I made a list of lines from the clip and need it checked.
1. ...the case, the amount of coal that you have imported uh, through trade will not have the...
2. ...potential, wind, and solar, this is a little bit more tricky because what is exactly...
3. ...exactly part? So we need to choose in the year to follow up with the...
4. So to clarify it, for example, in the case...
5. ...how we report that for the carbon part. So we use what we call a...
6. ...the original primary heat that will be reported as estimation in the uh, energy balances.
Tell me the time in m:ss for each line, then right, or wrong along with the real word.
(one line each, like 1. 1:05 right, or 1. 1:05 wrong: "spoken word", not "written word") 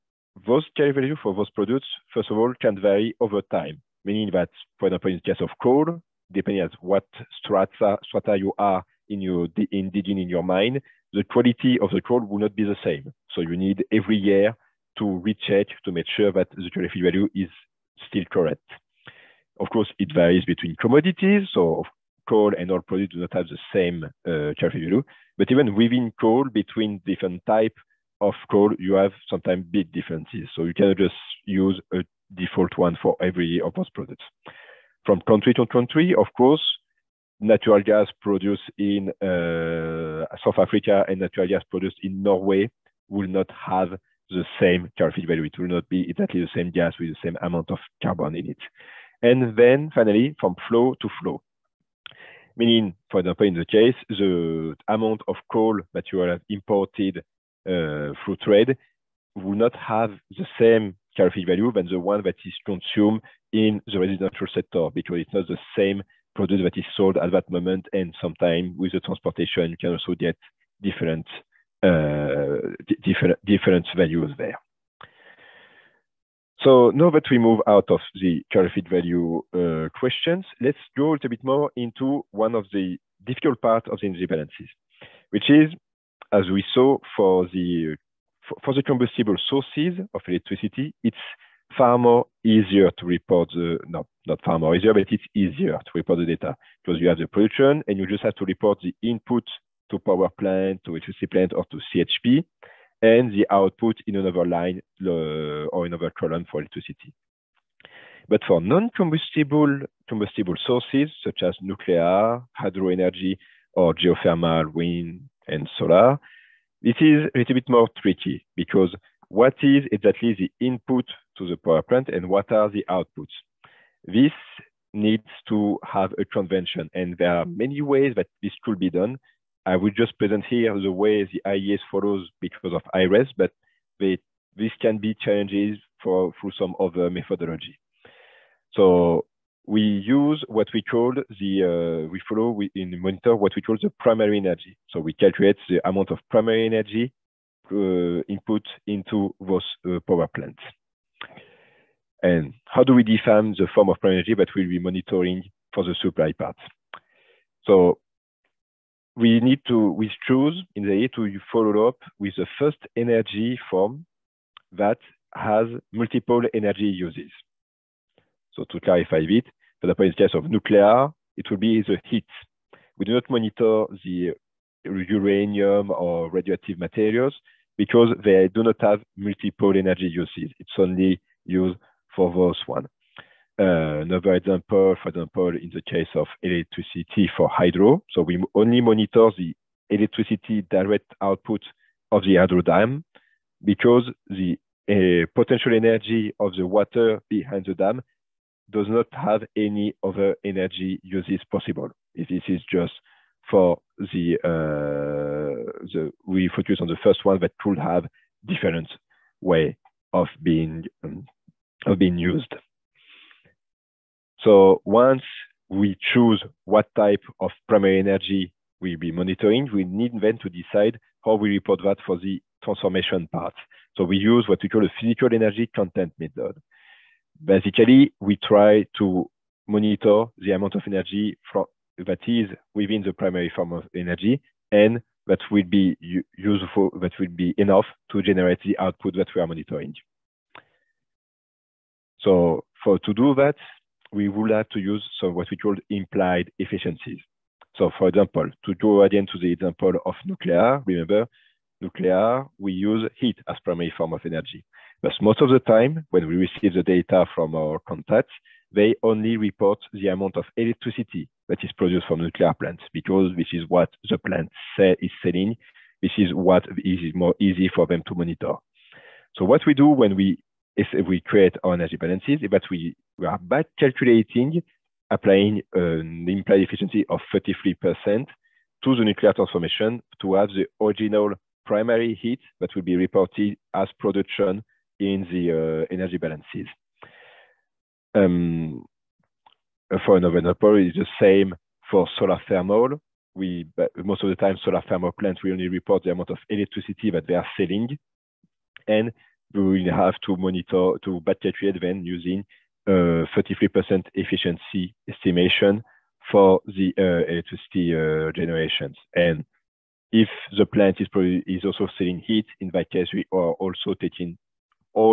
1. 0:53 right
2. 1:53 wrong: "geothermal", not "potential"
3. 2:36 wrong: "supply", not "exactly"
4. 2:48 right
5. 3:41 wrong: "transformation", not "carbon"
6. 4:40 wrong: "production", not "estimation".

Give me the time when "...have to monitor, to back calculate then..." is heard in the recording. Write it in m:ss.
4:59.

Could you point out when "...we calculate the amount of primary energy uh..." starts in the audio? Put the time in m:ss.
2:24.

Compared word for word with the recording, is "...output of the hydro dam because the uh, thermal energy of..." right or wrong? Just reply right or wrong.
wrong.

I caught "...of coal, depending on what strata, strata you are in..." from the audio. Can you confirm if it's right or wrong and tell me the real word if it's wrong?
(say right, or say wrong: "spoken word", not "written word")
right.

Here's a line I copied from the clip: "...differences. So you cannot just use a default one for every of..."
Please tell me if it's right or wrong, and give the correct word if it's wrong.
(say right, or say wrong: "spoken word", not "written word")
right.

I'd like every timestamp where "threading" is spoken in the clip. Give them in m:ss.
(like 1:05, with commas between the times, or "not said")
not said.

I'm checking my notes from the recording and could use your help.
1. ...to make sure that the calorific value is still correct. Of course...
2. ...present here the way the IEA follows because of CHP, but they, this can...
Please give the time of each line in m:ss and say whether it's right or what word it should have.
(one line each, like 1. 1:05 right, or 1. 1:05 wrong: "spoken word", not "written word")
1. 0:15 right
2. 2:10 wrong: "IRES", not "CHP".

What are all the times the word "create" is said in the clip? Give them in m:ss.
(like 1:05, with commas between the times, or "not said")
4:31.